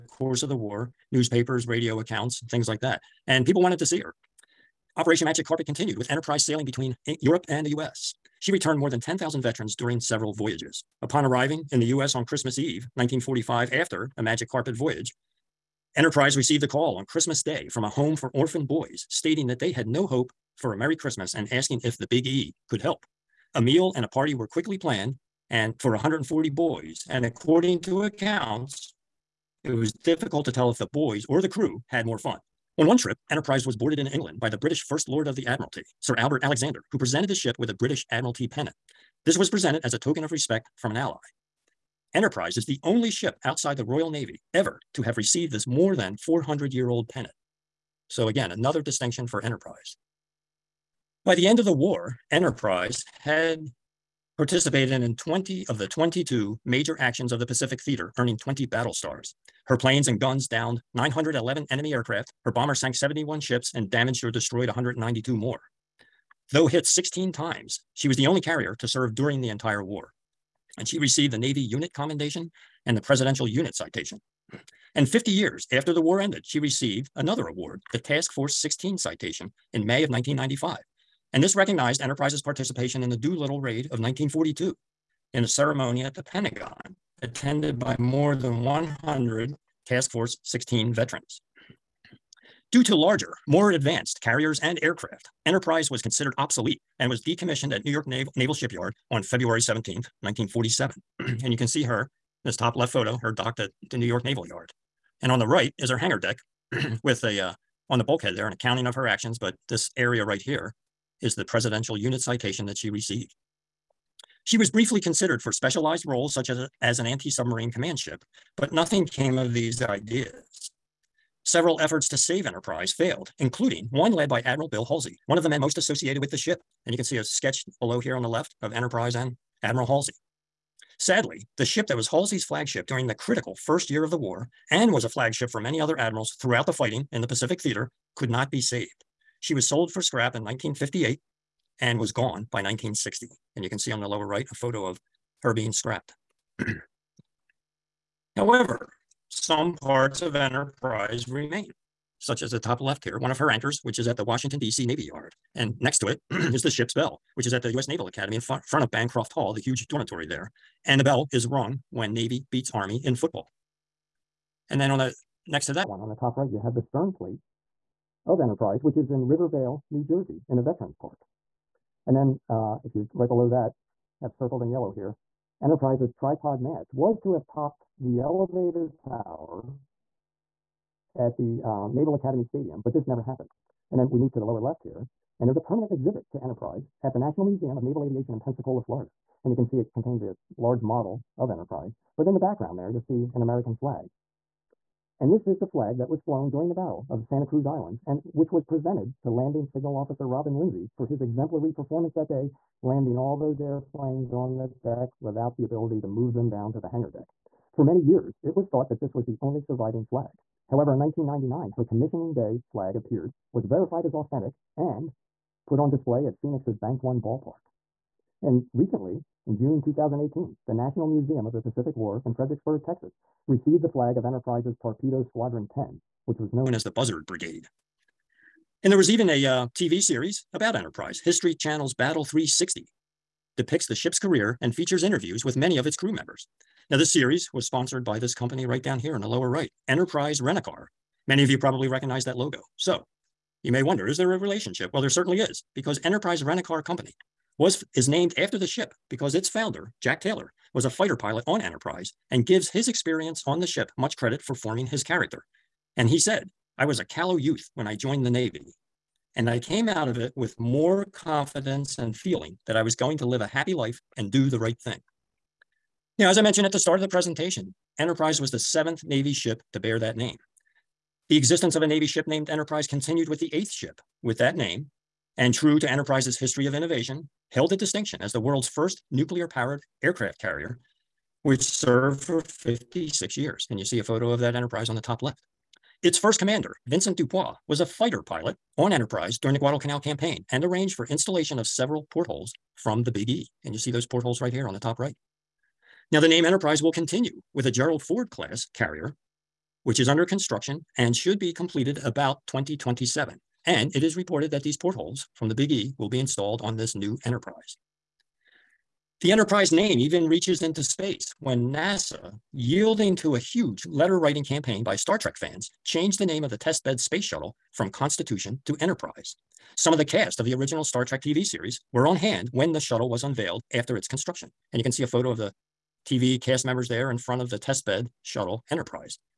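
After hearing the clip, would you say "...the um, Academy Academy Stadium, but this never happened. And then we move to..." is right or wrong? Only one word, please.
wrong.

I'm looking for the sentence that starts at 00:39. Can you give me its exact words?
This was presented as a token of respect from an ally.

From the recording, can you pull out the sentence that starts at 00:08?
She returned more than 10,000 veterans during several voyages.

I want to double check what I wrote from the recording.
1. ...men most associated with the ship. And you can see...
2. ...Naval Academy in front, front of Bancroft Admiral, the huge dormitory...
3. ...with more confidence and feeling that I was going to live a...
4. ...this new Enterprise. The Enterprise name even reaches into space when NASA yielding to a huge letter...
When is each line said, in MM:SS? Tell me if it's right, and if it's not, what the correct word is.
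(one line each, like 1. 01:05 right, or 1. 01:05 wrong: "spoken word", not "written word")
1. 02:05 right
2. 02:37 wrong: "Hall", not "Admiral"
3. 04:20 right
4. 05:06 right.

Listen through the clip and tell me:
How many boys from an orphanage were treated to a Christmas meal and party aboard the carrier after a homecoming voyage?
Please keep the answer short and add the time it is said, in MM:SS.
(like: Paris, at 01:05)
140, at 00:25.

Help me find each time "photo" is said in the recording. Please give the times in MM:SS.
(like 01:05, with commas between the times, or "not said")
01:42, 02:24, 04:44, 05:25.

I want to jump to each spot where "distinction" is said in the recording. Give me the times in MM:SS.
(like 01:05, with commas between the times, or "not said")
00:48, 04:37.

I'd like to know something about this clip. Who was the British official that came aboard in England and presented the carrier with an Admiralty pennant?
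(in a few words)
Sir Albert Alexander.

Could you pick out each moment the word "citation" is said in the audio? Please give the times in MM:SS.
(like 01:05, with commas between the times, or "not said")
01:13, 01:18, 01:52.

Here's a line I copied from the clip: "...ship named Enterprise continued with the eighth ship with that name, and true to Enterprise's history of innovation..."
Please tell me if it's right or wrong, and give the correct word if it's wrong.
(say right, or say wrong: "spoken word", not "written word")
right.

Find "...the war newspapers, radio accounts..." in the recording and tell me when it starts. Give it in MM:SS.
00:00.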